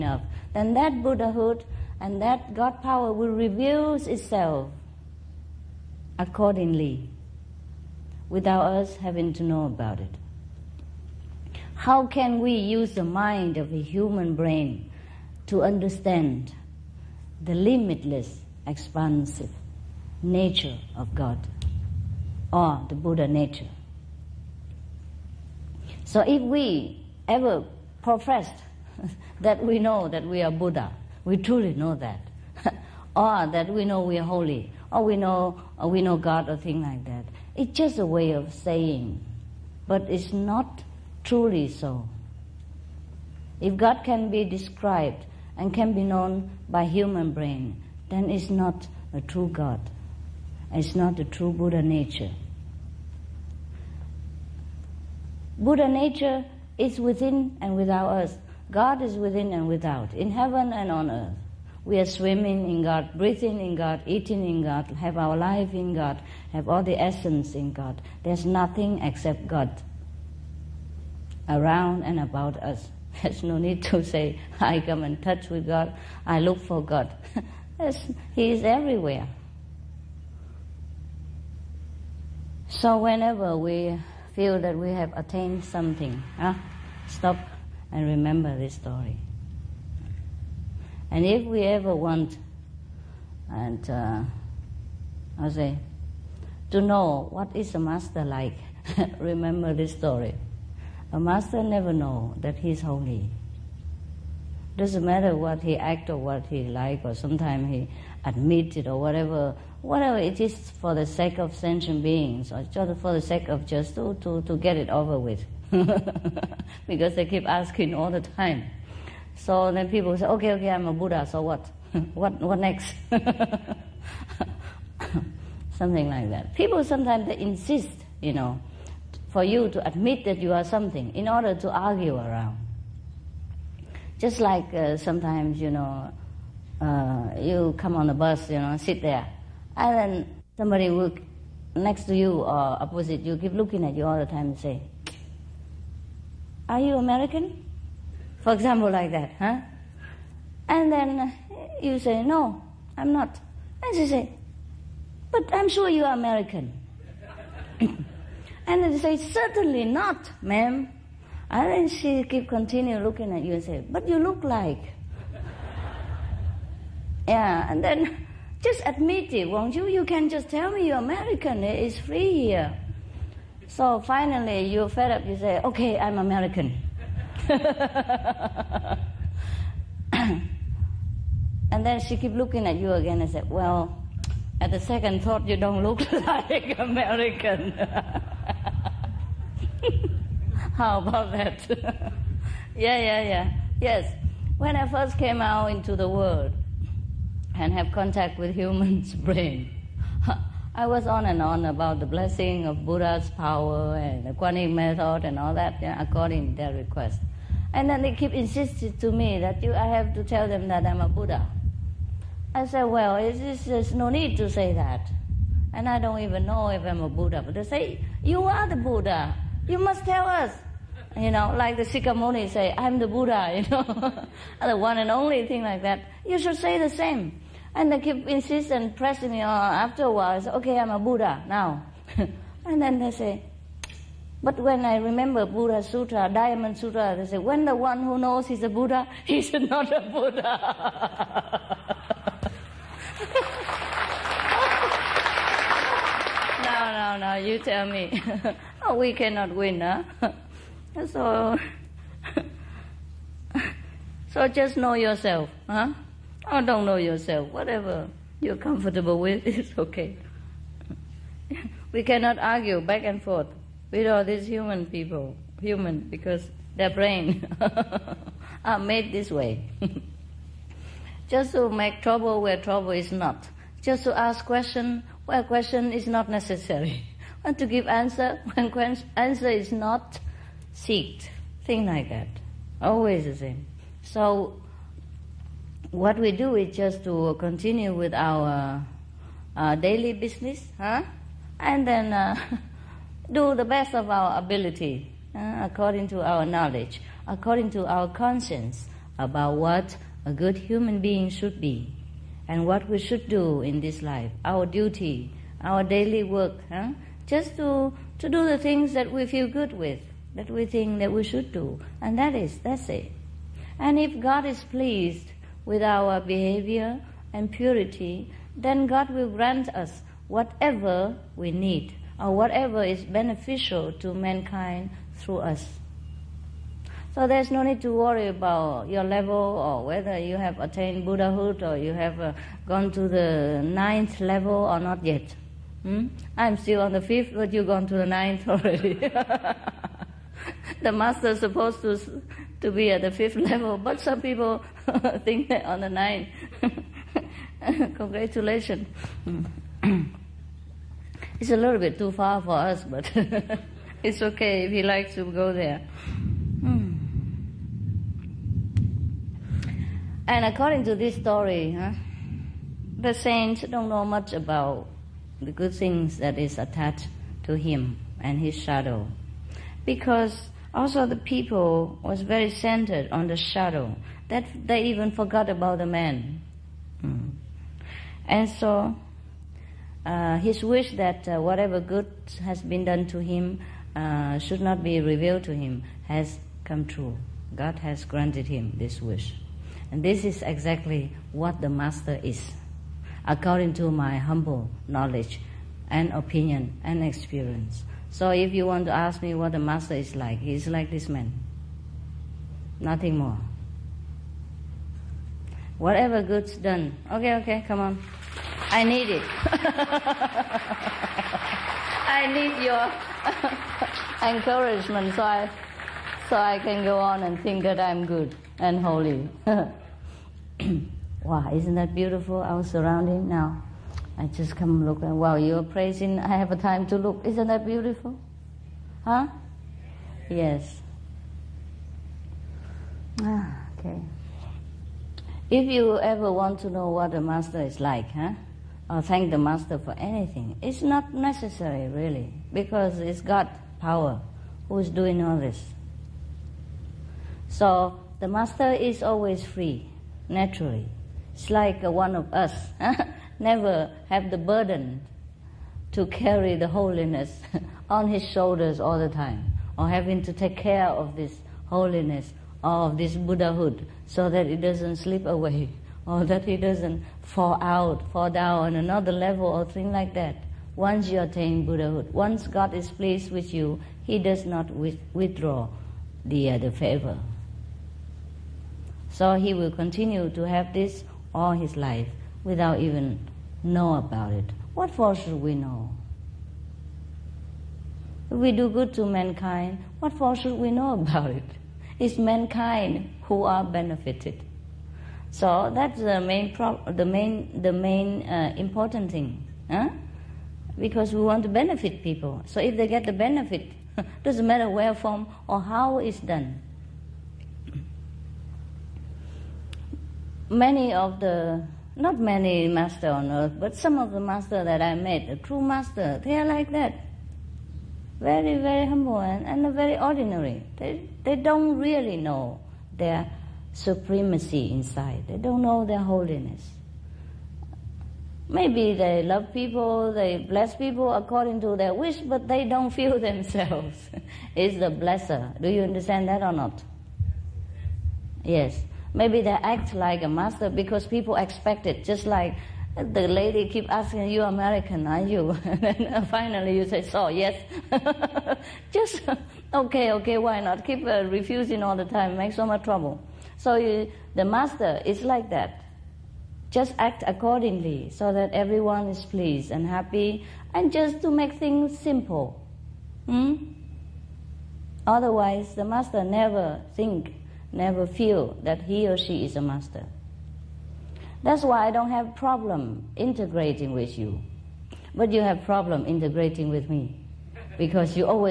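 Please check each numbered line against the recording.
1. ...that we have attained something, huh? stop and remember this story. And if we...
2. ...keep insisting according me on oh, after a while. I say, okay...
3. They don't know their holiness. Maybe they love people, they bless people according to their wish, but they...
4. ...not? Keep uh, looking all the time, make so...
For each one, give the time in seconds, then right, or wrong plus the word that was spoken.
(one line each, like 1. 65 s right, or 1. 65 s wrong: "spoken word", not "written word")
1. 84 s right
2. 228 s wrong: "pressing", not "according"
3. 525 s right
4. 550 s wrong: "refusing", not "looking".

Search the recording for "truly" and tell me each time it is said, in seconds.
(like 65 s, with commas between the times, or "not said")
31 s, 41 s.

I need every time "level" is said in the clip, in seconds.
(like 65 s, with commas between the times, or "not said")
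329 s, 334 s, 343 s, 469 s.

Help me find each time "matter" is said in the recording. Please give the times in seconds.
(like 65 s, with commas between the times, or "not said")
105 s, 504 s.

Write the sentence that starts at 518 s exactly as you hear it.
Very, very humble and, and very ordinary.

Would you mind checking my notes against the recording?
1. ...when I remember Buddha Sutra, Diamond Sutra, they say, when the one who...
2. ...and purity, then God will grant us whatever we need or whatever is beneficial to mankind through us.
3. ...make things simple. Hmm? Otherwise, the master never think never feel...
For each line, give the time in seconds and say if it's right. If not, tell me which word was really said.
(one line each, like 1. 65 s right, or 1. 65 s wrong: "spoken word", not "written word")
1. 234 s right
2. 317 s right
3. 561 s right.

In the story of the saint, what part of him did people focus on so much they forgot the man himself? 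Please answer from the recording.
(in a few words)
his shadow.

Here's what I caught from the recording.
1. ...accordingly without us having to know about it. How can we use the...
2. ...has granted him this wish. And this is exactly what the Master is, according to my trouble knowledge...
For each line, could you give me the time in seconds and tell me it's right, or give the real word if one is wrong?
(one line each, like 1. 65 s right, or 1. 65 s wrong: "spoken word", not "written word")
1. 6 s right
2. 387 s wrong: "humble", not "trouble".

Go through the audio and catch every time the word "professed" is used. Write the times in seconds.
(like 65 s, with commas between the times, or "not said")
28 s.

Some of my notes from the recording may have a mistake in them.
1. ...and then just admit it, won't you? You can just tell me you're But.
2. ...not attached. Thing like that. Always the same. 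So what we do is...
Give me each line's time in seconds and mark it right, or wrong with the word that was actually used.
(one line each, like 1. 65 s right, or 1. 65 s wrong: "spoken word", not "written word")
1. 167 s wrong: "American", not "But"
2. 279 s wrong: "seeked", not "attached".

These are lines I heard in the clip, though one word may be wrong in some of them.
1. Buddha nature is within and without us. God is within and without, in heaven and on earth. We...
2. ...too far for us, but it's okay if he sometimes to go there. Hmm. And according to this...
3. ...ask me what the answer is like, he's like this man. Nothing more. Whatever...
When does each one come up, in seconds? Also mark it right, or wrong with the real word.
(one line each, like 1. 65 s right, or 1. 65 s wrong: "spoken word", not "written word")
1. 55 s right
2. 351 s wrong: "likes", not "sometimes"
3. 398 s wrong: "master", not "answer".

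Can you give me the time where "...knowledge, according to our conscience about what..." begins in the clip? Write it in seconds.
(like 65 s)
296 s.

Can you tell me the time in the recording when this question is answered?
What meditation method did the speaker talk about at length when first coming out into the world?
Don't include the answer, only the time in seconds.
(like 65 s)
204 s.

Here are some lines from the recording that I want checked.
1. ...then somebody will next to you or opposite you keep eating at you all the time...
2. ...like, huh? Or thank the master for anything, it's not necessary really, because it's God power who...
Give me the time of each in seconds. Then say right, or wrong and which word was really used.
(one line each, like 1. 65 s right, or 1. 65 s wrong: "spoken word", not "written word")
1. 139 s wrong: "looking", not "eating"
2. 437 s right.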